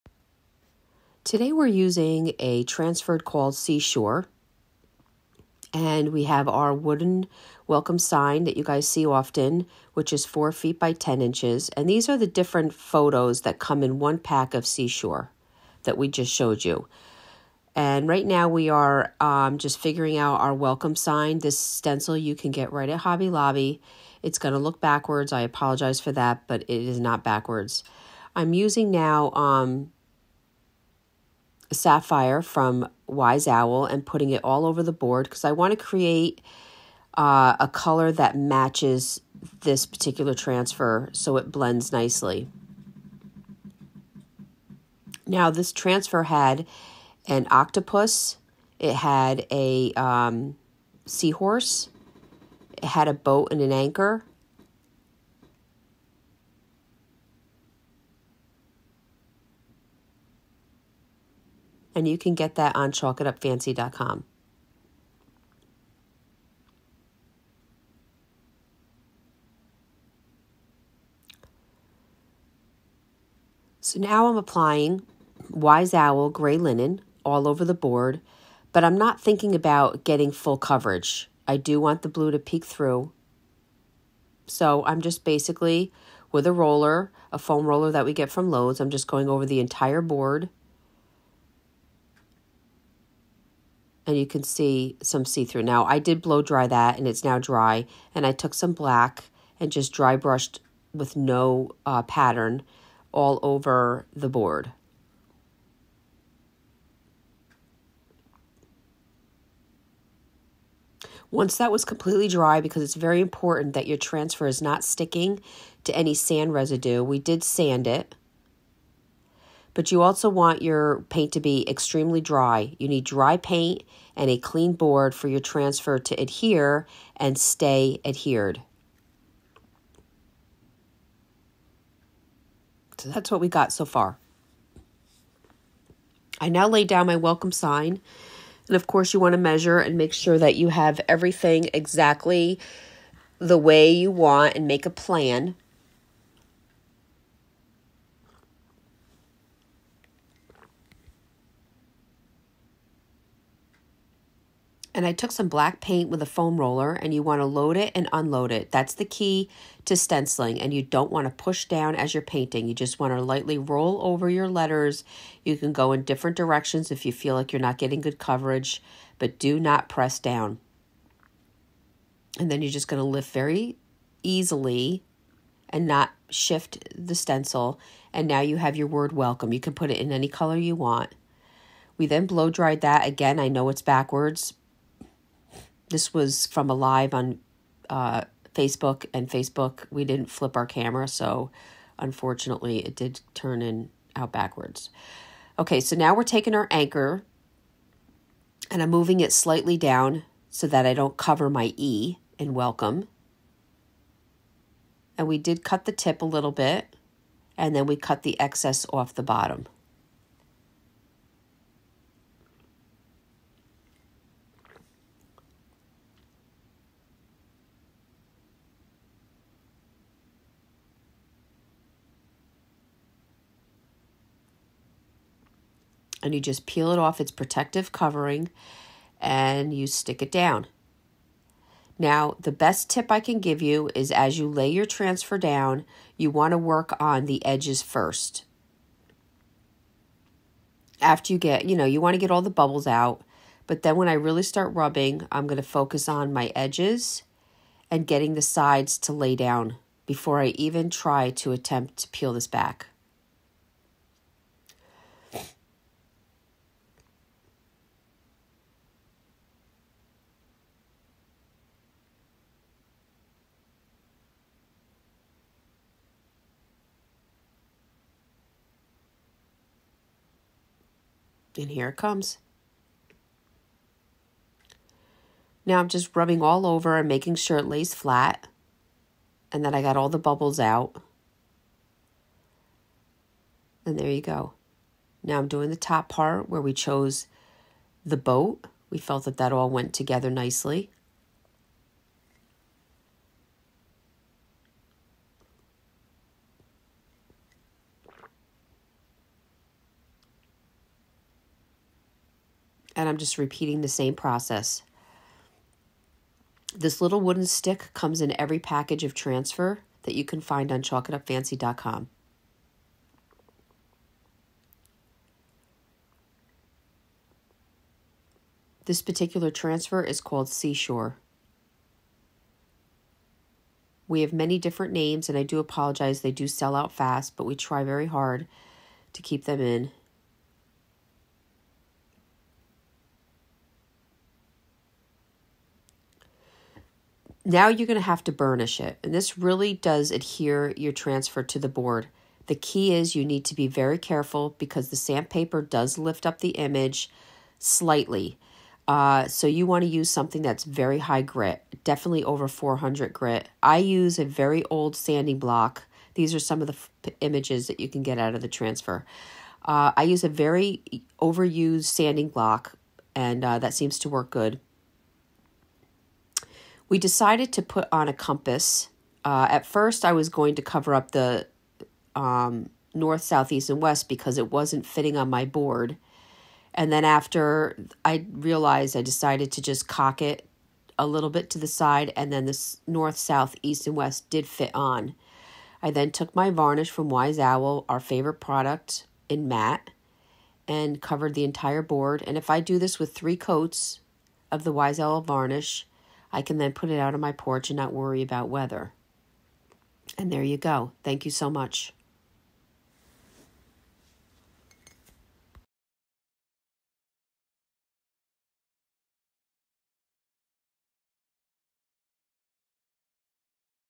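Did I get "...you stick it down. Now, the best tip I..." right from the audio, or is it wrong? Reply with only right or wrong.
right.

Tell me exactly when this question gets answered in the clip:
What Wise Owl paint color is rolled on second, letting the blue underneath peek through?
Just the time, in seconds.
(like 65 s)
76 s.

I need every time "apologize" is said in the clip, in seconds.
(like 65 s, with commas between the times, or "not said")
25 s, 325 s.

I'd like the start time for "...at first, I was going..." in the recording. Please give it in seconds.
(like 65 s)
369 s.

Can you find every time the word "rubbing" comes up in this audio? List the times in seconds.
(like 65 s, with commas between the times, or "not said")
244 s, 276 s.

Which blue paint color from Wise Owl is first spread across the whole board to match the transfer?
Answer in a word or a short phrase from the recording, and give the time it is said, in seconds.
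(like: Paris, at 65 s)
Sapphire, at 31 s.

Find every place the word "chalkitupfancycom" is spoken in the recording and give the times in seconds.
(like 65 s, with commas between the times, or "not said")
62 s, 310 s.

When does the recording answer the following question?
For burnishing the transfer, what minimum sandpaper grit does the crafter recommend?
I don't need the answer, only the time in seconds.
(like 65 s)
352 s.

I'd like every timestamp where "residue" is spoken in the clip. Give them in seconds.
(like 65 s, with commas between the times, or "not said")
116 s.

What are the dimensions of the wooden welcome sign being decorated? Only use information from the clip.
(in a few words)
4 feet by 10 inches.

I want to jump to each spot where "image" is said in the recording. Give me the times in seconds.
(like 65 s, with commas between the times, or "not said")
346 s, 357 s.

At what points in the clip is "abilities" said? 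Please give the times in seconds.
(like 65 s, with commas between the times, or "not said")
not said.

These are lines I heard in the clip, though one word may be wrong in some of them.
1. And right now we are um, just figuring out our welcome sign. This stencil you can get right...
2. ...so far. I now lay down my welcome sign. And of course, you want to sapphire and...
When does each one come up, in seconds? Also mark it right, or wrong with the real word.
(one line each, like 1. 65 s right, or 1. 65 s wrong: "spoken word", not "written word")
1. 17 s right
2. 133 s wrong: "measure", not "sapphire".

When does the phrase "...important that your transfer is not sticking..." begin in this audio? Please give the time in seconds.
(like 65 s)
113 s.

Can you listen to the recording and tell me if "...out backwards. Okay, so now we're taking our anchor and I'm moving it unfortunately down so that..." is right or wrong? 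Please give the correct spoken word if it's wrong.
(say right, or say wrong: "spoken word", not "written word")
wrong: "slightly", not "unfortunately".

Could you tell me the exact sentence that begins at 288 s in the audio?
We felt that that all went together nicely.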